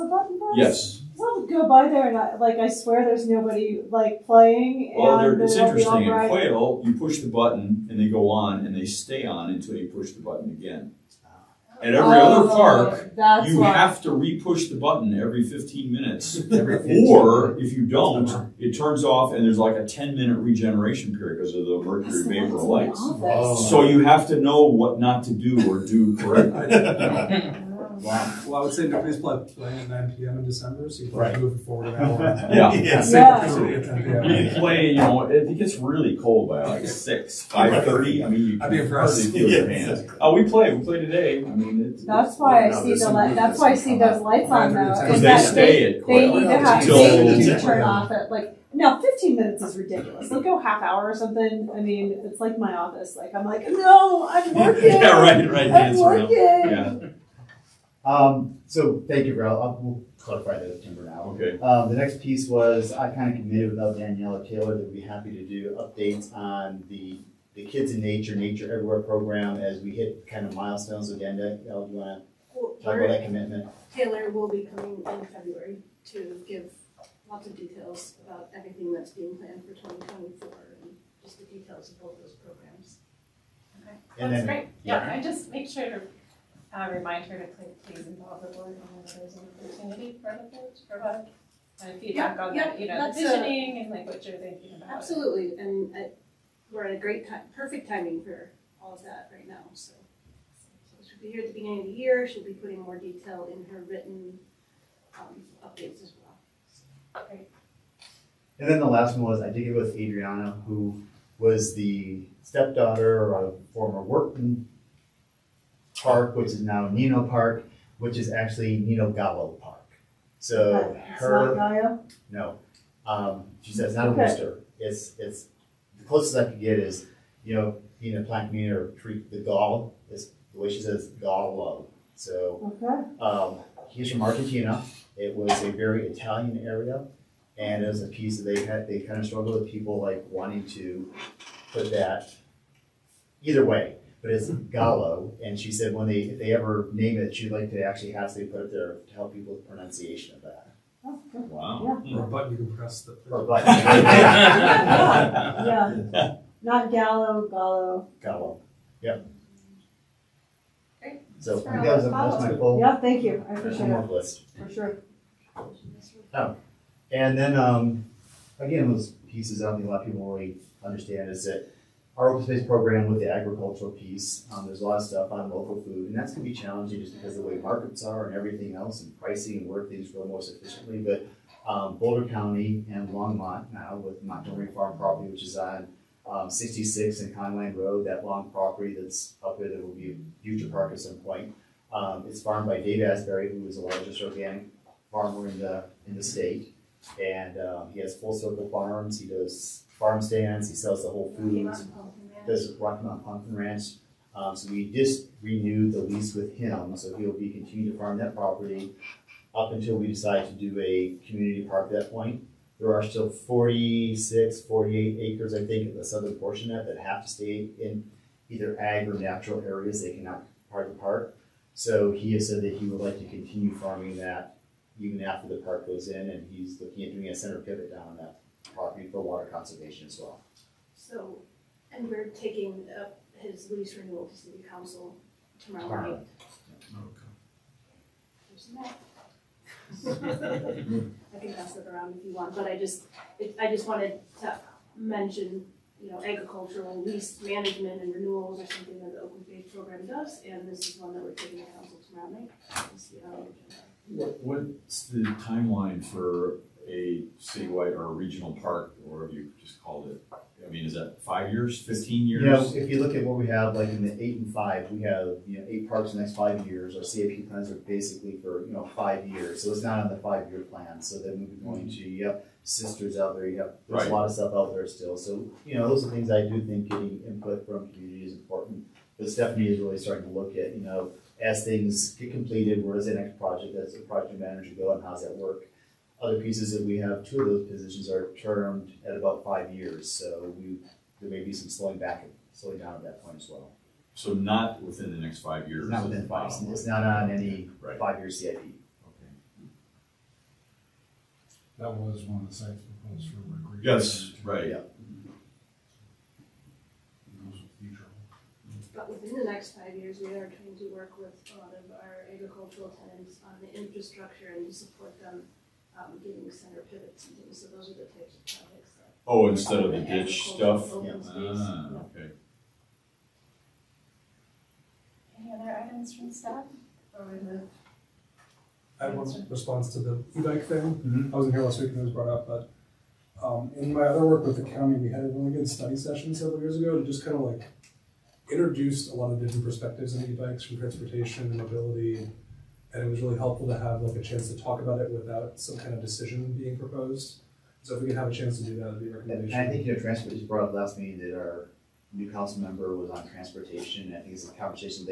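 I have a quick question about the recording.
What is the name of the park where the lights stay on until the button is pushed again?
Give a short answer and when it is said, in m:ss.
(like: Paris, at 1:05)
Quail, at 0:06.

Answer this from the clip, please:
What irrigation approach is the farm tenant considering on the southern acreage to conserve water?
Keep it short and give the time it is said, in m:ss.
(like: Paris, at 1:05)
center pivot, at 3:47.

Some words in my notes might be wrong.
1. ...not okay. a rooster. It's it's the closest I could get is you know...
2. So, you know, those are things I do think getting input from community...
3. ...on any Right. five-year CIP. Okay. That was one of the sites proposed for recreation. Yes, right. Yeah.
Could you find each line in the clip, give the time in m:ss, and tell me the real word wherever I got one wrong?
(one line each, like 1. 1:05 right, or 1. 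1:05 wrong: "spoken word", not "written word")
1. 2:03 right
2. 4:35 right
3. 4:57 right.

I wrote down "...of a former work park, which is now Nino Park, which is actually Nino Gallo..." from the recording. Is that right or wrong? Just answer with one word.
right.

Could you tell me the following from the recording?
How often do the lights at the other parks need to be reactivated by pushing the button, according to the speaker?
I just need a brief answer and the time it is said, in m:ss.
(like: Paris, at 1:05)
every 15 minutes, at 0:15.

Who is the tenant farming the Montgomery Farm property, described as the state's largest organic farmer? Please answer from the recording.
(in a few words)
Dave Asmus.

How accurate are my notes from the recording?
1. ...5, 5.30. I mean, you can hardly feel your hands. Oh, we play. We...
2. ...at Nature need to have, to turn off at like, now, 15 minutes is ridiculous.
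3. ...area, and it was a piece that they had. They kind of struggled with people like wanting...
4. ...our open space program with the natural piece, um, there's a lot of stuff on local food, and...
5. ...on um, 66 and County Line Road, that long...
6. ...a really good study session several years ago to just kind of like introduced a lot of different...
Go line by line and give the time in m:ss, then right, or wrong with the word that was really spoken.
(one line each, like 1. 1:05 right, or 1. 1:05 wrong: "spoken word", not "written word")
1. 0:36 wrong: "6", not "5"
2. 0:45 wrong: "They", not "Nature"
3. 2:16 right
4. 2:52 wrong: "agricultural", not "natural"
5. 3:05 right
6. 5:35 right.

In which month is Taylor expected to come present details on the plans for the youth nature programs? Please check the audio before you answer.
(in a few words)
February.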